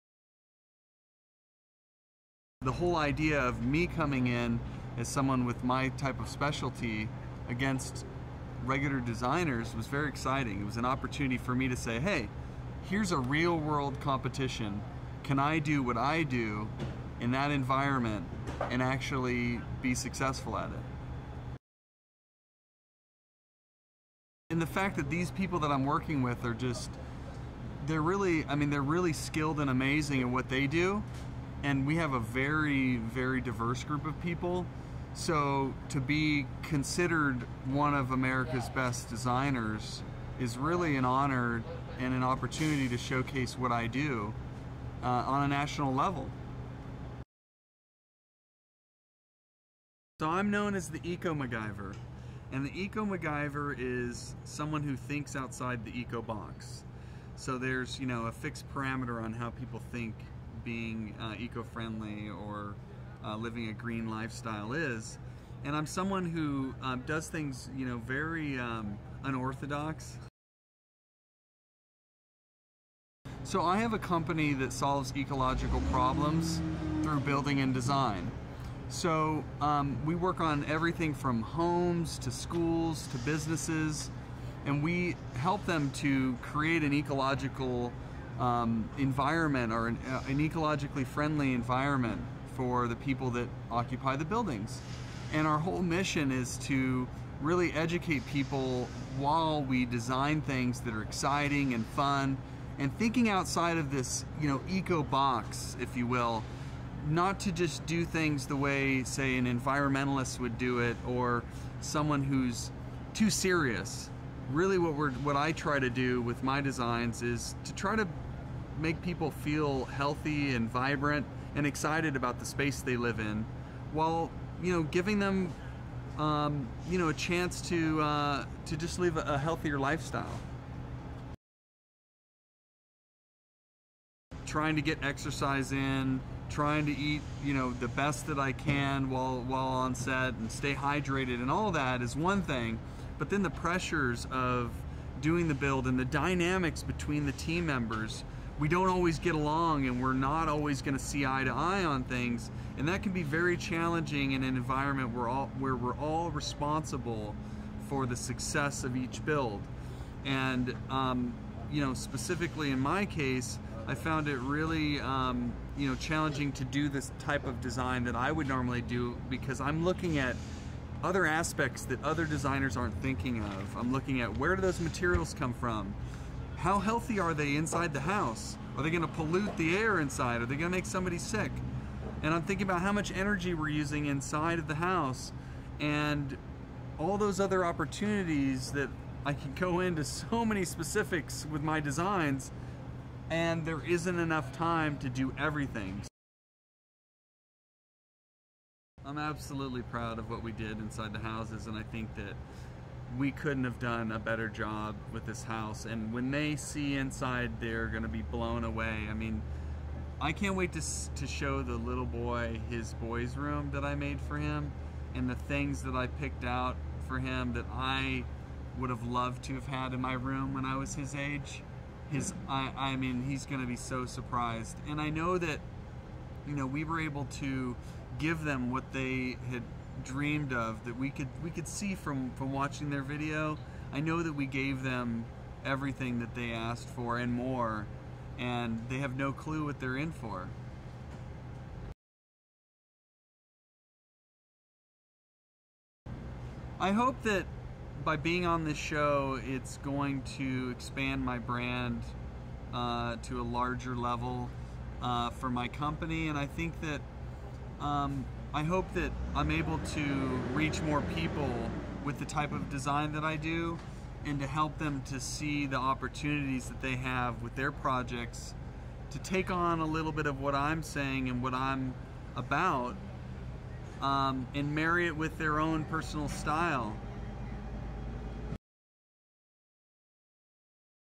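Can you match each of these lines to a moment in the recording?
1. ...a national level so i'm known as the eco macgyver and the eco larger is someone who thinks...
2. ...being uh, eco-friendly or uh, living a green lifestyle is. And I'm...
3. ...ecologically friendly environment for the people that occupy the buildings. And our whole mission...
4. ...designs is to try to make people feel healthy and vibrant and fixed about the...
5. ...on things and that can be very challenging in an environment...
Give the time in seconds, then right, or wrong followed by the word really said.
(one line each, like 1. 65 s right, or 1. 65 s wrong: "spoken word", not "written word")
1. 45 s wrong: "macgyver", not "larger"
2. 60 s right
3. 90 s right
4. 116 s wrong: "excited", not "fixed"
5. 151 s right.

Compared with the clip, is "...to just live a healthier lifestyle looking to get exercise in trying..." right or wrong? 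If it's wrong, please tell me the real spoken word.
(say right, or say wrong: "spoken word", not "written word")
wrong: "trying", not "looking".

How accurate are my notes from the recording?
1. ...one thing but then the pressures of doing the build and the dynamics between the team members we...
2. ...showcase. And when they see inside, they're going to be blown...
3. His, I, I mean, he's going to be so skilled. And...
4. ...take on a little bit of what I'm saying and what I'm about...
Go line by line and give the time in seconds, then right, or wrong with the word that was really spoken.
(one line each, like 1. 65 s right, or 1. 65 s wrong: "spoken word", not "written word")
1. 142 s right
2. 205 s wrong: "house", not "showcase"
3. 222 s wrong: "surprised", not "skilled"
4. 269 s right.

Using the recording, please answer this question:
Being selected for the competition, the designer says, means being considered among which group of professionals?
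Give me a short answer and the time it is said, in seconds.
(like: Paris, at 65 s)
America's best designers, at 38 s.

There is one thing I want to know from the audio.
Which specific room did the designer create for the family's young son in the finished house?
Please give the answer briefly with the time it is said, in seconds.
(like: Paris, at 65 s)
his boy's room, at 212 s.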